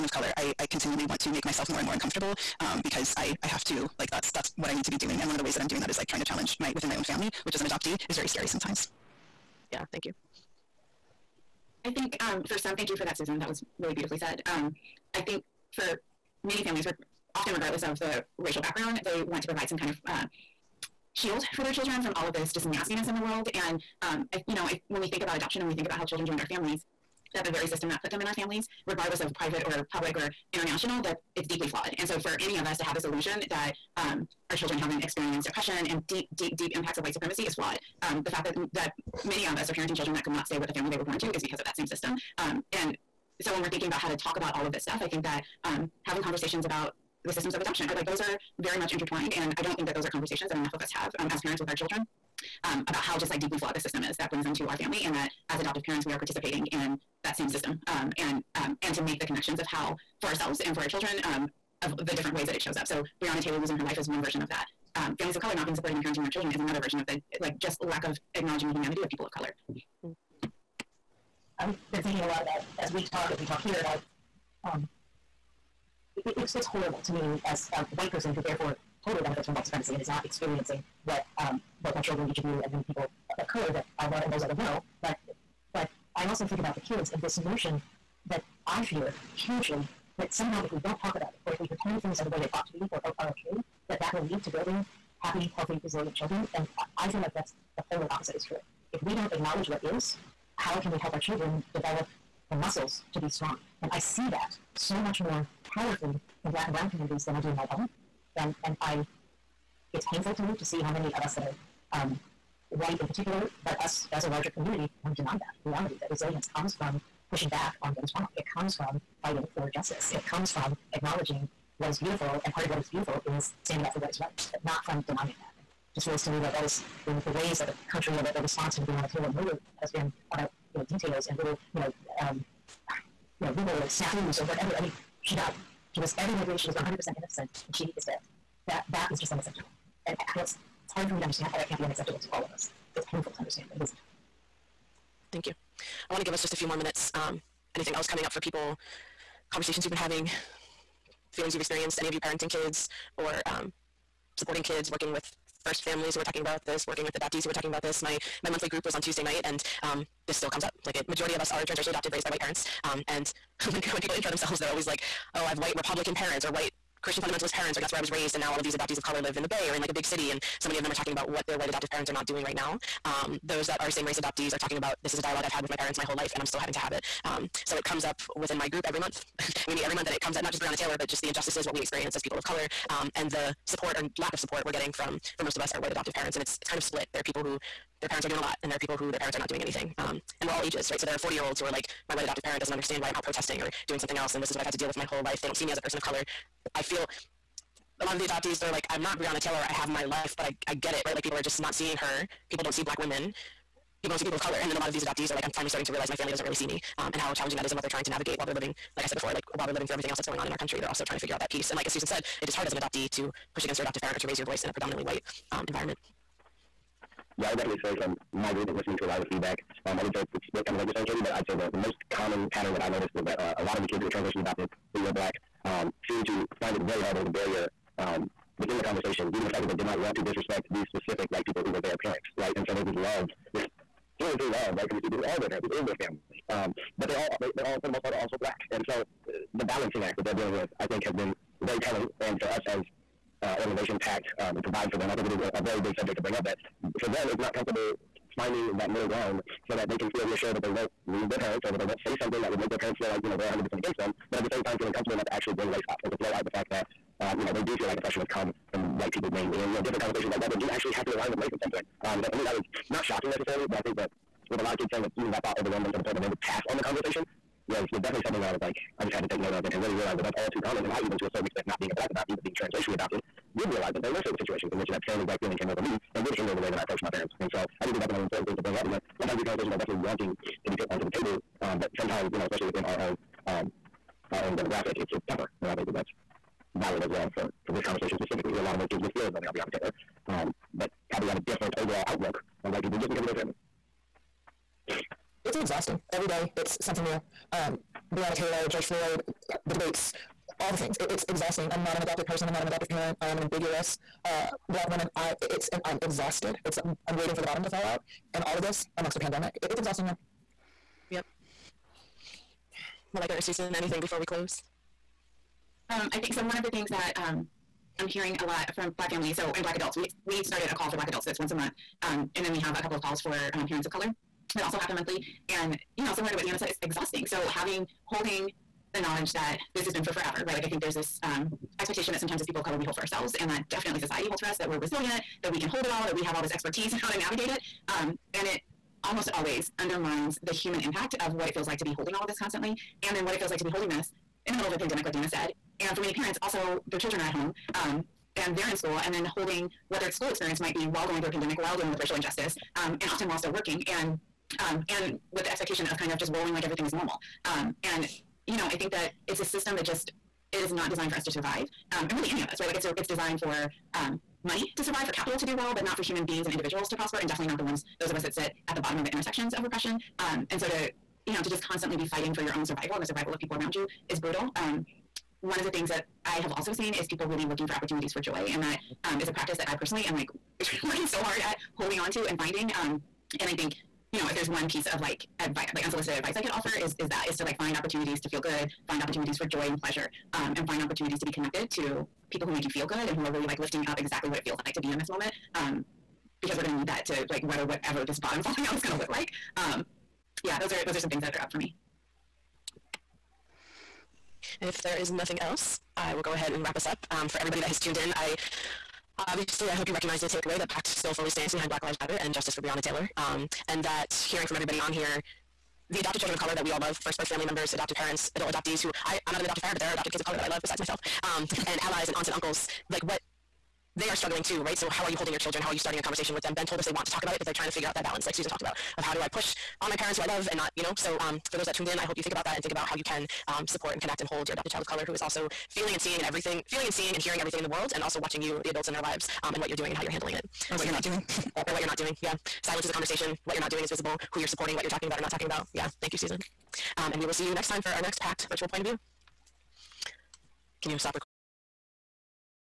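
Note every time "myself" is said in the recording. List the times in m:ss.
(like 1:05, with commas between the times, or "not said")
0:01, 7:00.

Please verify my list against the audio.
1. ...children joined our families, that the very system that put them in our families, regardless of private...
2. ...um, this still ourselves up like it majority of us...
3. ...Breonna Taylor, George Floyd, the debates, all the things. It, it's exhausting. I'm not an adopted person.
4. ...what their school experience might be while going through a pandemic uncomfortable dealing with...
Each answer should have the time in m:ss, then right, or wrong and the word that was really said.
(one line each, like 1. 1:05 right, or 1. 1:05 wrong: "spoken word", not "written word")
1. 0:26 right
2. 2:39 wrong: "comes", not "ourselves"
3. 4:58 right
4. 5:49 wrong: "while", not "uncomfortable".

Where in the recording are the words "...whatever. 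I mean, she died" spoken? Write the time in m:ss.
2:14.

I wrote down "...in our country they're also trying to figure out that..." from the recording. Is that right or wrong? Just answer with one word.
right.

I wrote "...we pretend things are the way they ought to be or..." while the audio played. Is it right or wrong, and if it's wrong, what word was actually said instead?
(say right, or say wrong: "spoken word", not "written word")
right.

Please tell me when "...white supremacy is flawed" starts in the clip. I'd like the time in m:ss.
0:37.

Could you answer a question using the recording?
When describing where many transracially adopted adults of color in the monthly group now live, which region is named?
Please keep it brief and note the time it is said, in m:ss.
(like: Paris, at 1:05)
the Bay, at 2:49.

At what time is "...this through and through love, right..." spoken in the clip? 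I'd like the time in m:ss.
3:53.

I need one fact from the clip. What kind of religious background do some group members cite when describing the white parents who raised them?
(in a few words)
Christian fundamentalist.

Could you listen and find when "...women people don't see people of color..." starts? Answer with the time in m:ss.
3:22.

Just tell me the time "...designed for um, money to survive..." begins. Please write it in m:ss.
6:03.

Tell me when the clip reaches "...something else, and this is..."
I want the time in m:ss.
3:13.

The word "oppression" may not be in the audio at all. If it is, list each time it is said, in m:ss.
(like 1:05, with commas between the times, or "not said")
0:35, 4:17.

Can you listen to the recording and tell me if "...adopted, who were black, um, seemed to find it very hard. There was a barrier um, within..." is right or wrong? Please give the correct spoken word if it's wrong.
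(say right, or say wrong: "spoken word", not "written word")
right.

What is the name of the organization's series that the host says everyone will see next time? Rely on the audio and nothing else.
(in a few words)
PACT virtual point of view.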